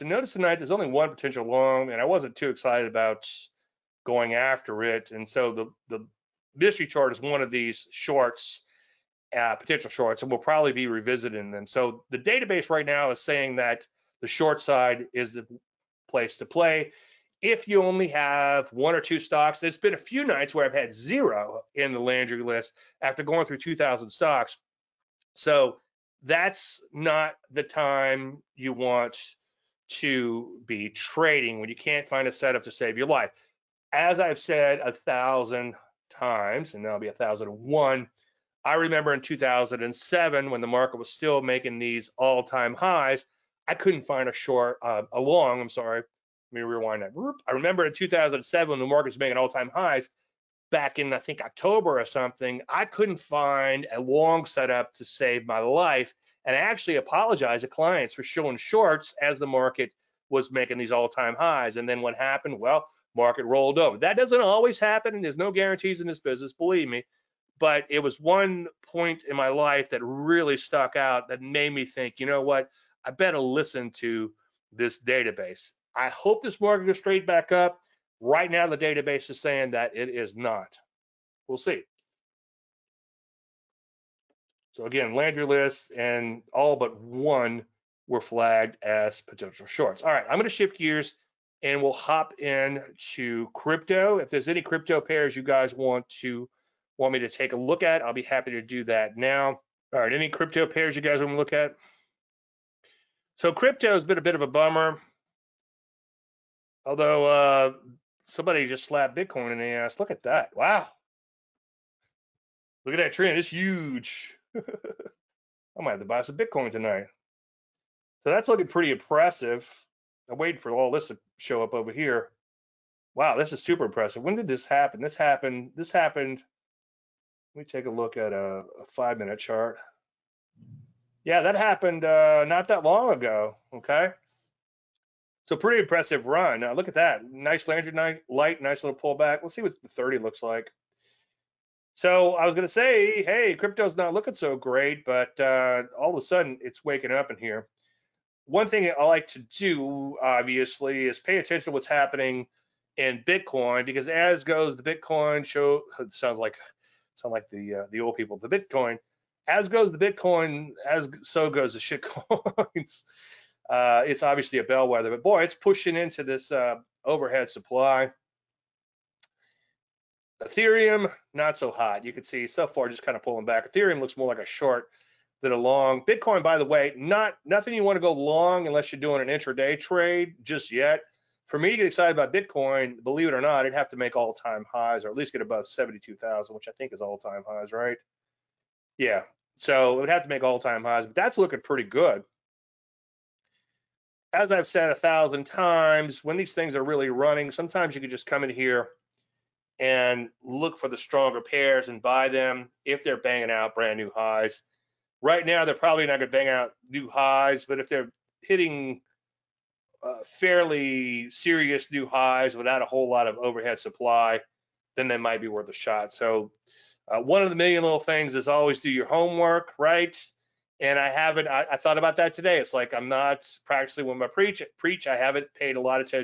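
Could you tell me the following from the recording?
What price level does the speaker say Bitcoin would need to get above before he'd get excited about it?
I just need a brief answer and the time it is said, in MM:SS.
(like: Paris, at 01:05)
72,000, at 03:05.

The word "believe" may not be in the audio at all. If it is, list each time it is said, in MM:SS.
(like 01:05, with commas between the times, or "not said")
01:06, 03:03.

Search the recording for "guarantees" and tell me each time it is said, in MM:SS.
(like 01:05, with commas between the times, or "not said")
01:05.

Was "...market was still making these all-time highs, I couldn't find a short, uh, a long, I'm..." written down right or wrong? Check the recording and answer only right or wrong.
right.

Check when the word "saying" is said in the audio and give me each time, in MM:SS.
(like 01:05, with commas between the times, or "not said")
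00:13, 01:19.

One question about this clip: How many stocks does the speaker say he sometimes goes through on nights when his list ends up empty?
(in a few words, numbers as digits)
2,000.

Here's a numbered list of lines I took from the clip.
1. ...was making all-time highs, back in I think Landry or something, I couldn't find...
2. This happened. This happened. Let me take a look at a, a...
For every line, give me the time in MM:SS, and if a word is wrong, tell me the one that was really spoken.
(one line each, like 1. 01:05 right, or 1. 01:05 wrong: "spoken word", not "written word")
1. 00:49 wrong: "October", not "Landry"
2. 02:04 right.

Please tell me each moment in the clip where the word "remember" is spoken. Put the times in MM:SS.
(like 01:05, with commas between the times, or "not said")
00:38, 00:47.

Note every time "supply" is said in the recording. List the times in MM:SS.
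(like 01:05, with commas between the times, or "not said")
02:47, 03:33.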